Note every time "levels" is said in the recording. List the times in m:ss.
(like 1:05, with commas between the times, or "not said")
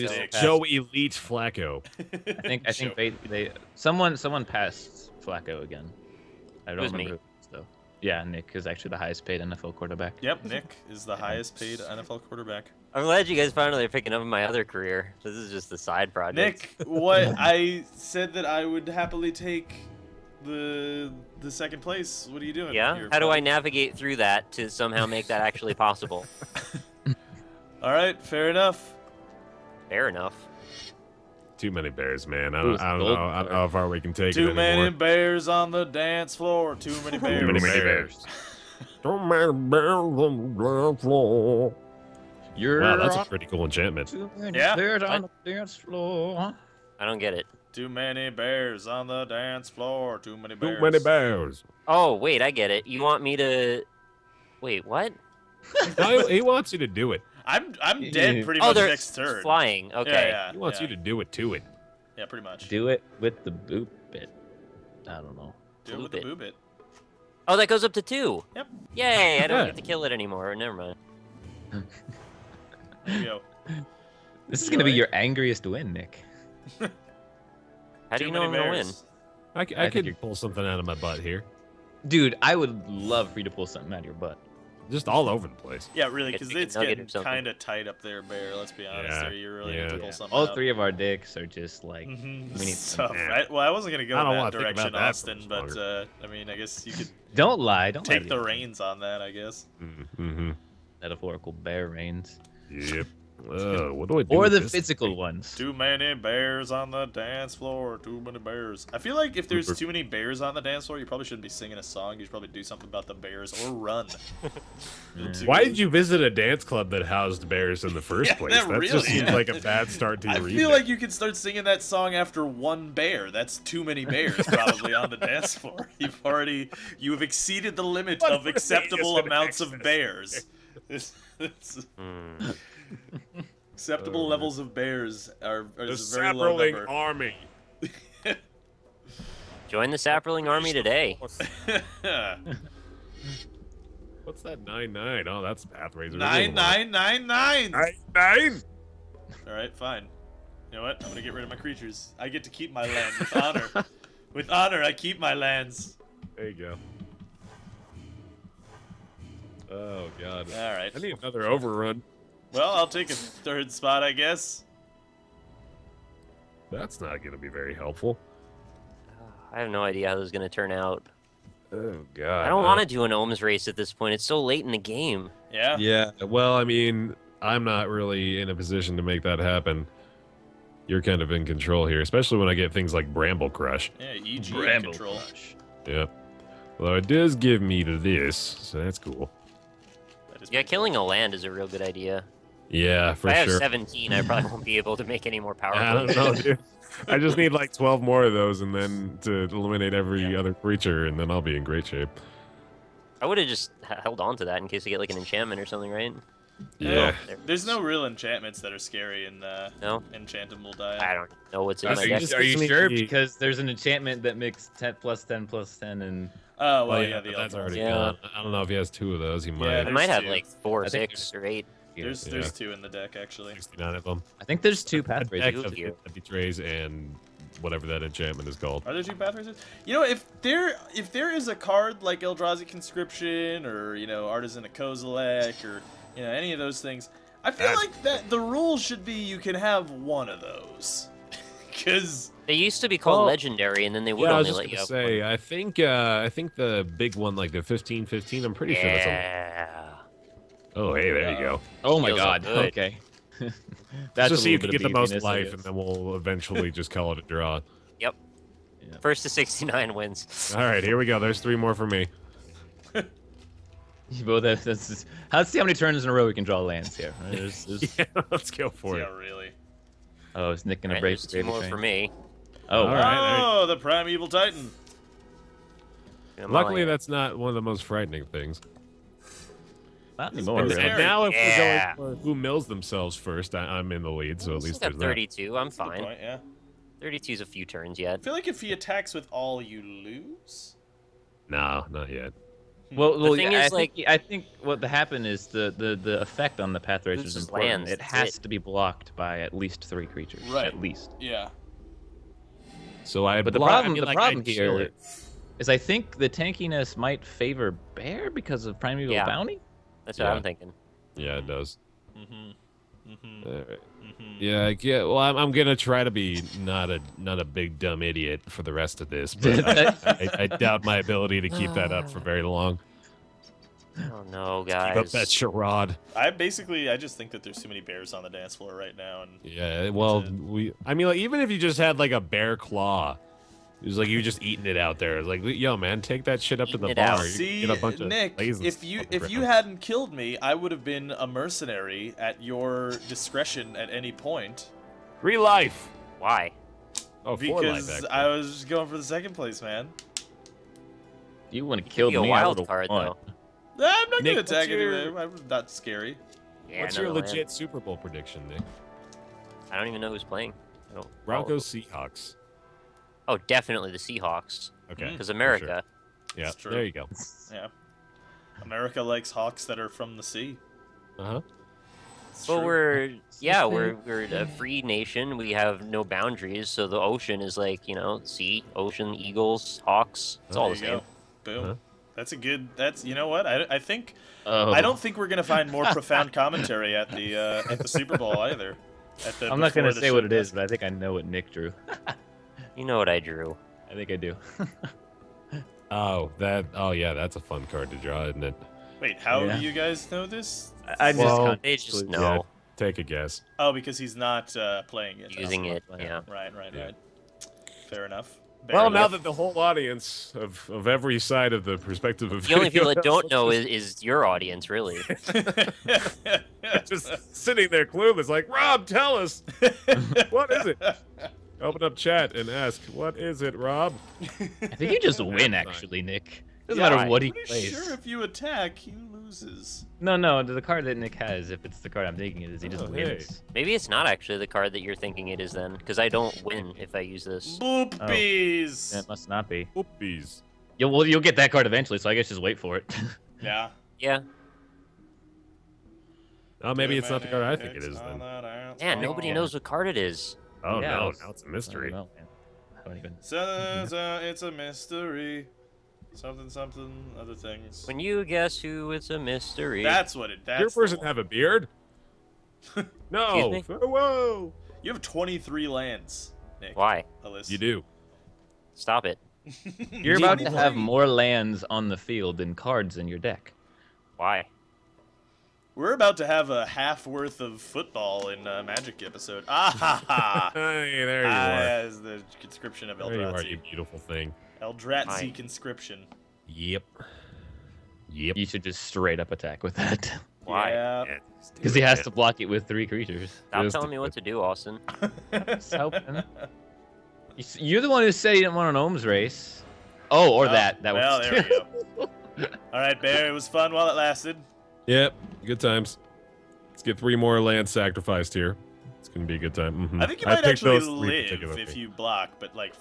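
2:14.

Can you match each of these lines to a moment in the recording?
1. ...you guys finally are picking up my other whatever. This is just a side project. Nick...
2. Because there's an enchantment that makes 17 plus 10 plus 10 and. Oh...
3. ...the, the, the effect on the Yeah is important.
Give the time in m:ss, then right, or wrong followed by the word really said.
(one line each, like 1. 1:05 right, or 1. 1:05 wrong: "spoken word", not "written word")
1. 0:13 wrong: "career", not "whatever"
2. 3:32 wrong: "10", not "17"
3. 4:55 wrong: "Pathrazer", not "Yeah".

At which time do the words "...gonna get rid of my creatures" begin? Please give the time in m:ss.
2:31.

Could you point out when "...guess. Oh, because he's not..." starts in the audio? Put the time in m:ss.
6:43.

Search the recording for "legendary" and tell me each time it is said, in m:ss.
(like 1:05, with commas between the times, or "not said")
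4:03.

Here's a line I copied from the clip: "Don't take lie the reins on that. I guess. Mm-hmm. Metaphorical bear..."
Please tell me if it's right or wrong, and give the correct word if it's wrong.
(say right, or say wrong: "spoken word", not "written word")
right.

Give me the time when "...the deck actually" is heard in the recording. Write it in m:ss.
3:42.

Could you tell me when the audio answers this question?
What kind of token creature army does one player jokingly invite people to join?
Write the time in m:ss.
2:19.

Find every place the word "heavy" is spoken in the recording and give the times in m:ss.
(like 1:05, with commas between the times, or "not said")
not said.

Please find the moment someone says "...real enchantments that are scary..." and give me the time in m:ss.
3:27.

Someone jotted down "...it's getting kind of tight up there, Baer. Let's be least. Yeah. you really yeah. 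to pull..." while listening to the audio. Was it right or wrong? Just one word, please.
wrong.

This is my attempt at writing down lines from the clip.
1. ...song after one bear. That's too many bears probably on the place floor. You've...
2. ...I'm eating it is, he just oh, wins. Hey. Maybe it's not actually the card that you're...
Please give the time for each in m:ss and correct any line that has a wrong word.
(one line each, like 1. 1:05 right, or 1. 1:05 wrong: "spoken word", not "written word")
1. 2:01 wrong: "dance", not "place"
2. 7:12 wrong: "thinking", not "eating".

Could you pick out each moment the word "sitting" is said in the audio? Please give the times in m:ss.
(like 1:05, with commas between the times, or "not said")
6:57.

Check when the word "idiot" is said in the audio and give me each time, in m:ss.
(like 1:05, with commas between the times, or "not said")
5:18.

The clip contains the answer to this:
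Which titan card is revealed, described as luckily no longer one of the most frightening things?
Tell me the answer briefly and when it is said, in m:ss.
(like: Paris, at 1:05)
Primeval Titan, at 4:33.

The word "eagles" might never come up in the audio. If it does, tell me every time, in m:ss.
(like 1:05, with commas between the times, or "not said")
6:19.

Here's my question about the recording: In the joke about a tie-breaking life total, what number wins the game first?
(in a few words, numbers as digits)
69.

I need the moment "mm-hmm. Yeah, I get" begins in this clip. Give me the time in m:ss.
5:13.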